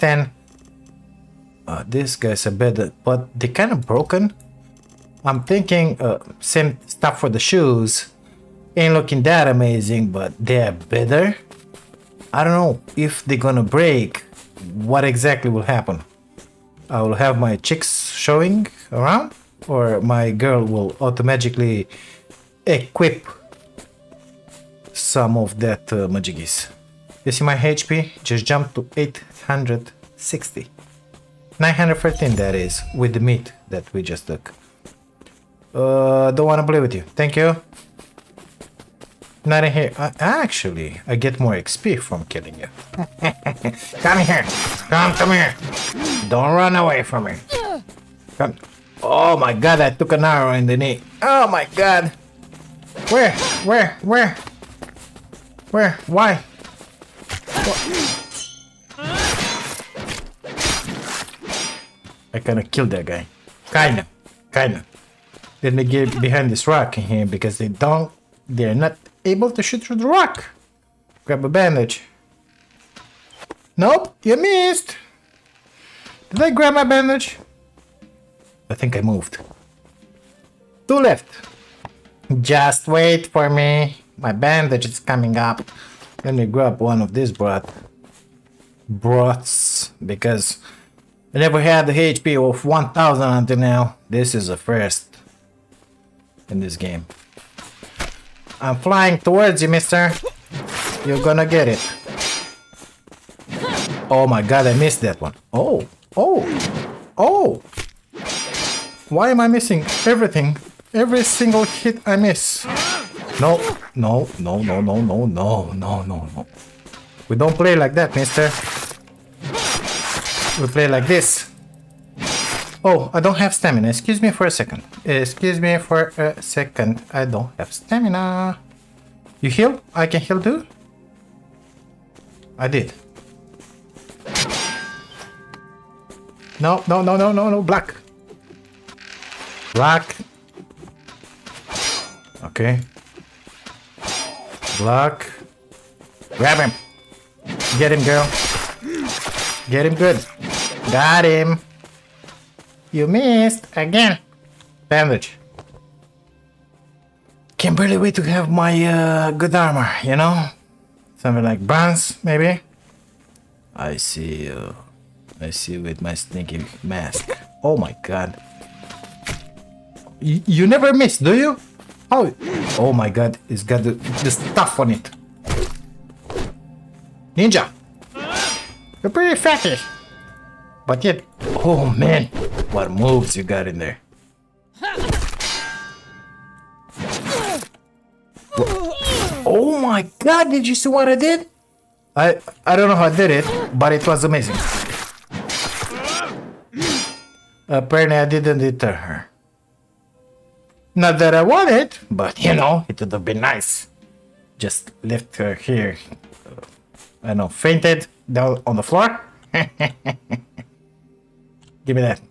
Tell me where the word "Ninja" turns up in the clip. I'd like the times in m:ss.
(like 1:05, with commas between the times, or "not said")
2:57.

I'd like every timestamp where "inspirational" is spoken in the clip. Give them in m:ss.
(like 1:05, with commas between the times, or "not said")
not said.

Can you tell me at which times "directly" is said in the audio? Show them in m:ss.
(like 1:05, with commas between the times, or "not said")
not said.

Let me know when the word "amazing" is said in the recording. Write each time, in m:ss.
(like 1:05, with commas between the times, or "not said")
0:09, 3:14.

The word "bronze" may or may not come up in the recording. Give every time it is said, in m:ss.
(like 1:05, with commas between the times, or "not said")
2:41.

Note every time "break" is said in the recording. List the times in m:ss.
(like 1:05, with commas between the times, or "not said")
0:13.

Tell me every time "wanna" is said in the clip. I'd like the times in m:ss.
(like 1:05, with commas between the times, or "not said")
0:36.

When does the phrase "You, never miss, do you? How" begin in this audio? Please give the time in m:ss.
2:50.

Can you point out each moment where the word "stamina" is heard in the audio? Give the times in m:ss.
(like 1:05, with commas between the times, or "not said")
2:03, 2:07.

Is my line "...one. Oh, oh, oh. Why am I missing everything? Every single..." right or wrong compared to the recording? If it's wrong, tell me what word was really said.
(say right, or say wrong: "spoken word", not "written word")
right.